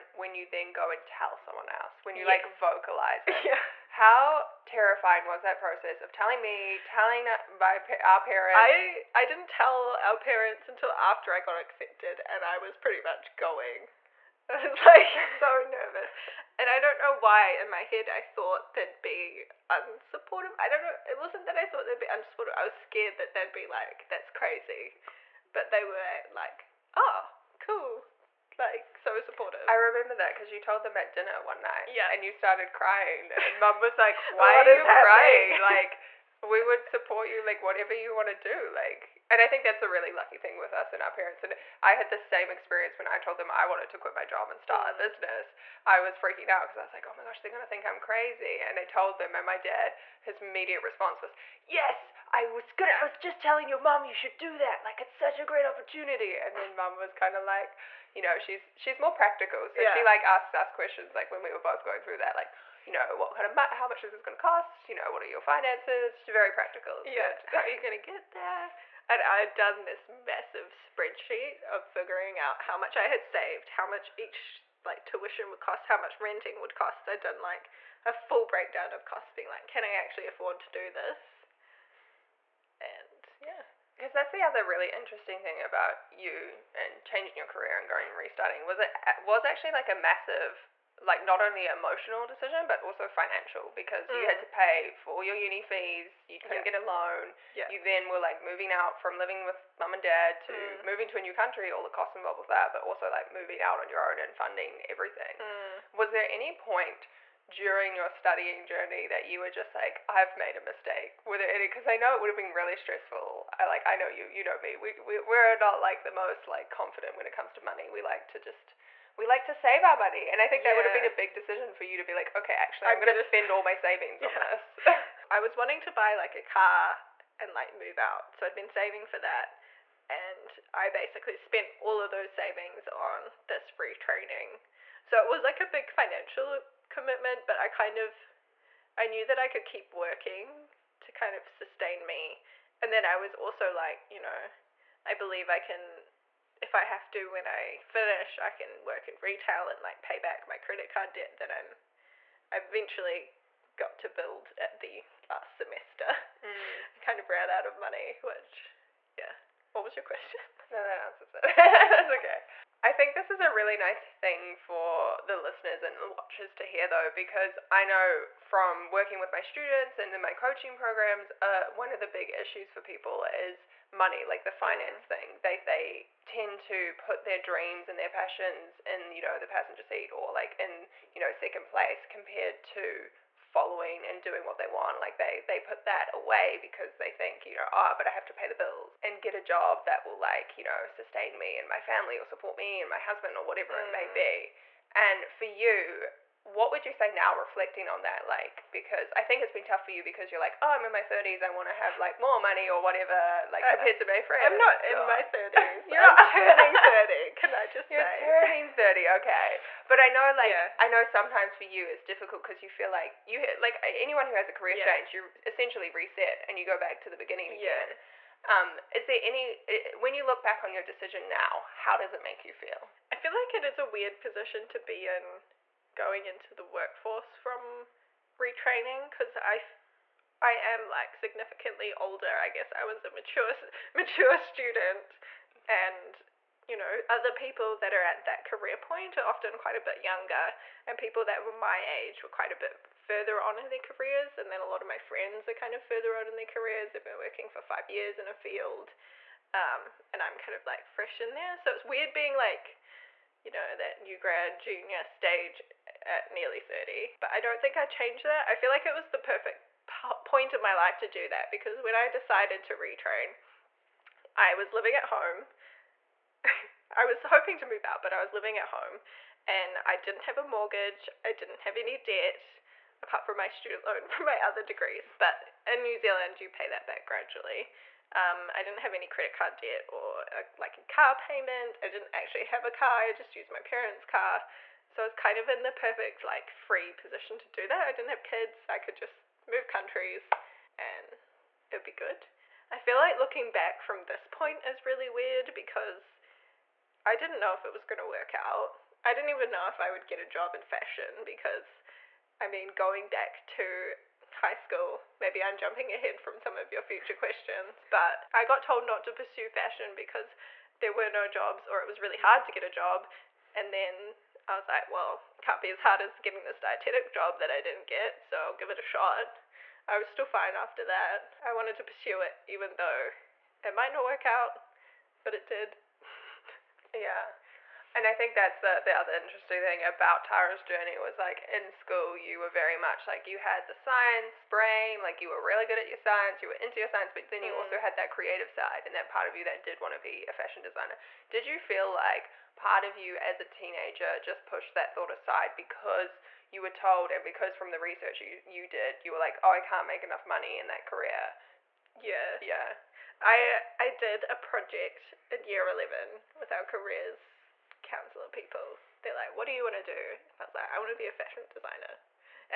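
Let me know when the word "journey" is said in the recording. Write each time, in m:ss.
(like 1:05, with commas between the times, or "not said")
1:48, 5:30.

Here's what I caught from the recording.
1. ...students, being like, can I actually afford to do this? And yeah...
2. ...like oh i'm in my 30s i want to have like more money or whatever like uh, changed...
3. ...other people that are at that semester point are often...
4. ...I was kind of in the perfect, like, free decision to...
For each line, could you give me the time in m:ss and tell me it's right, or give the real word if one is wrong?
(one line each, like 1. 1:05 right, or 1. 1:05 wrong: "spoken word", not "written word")
1. 1:19 wrong: "costs", not "students"
2. 3:20 wrong: "compared", not "changed"
3. 3:57 wrong: "career", not "semester"
4. 4:45 wrong: "position", not "decision".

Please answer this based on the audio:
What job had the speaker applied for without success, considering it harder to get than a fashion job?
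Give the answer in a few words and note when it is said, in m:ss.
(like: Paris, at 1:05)
Dietetic job, at 5:16.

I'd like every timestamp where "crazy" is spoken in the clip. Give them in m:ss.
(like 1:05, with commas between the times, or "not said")
0:24, 0:47.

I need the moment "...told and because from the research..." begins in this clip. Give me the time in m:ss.
5:46.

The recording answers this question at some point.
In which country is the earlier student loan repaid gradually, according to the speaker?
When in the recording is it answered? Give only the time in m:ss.
4:35.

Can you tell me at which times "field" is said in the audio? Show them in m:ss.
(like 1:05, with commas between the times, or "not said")
4:08.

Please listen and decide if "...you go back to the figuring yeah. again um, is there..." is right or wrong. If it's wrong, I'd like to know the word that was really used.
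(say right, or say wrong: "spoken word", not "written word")
wrong: "beginning", not "figuring".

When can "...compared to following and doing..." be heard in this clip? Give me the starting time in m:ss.
3:02.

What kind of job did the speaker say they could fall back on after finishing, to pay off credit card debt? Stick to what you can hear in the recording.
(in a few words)
Retail.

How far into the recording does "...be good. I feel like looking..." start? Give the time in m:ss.
4:51.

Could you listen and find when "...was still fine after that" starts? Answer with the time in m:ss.
5:19.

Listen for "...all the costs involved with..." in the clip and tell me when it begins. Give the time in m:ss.
1:41.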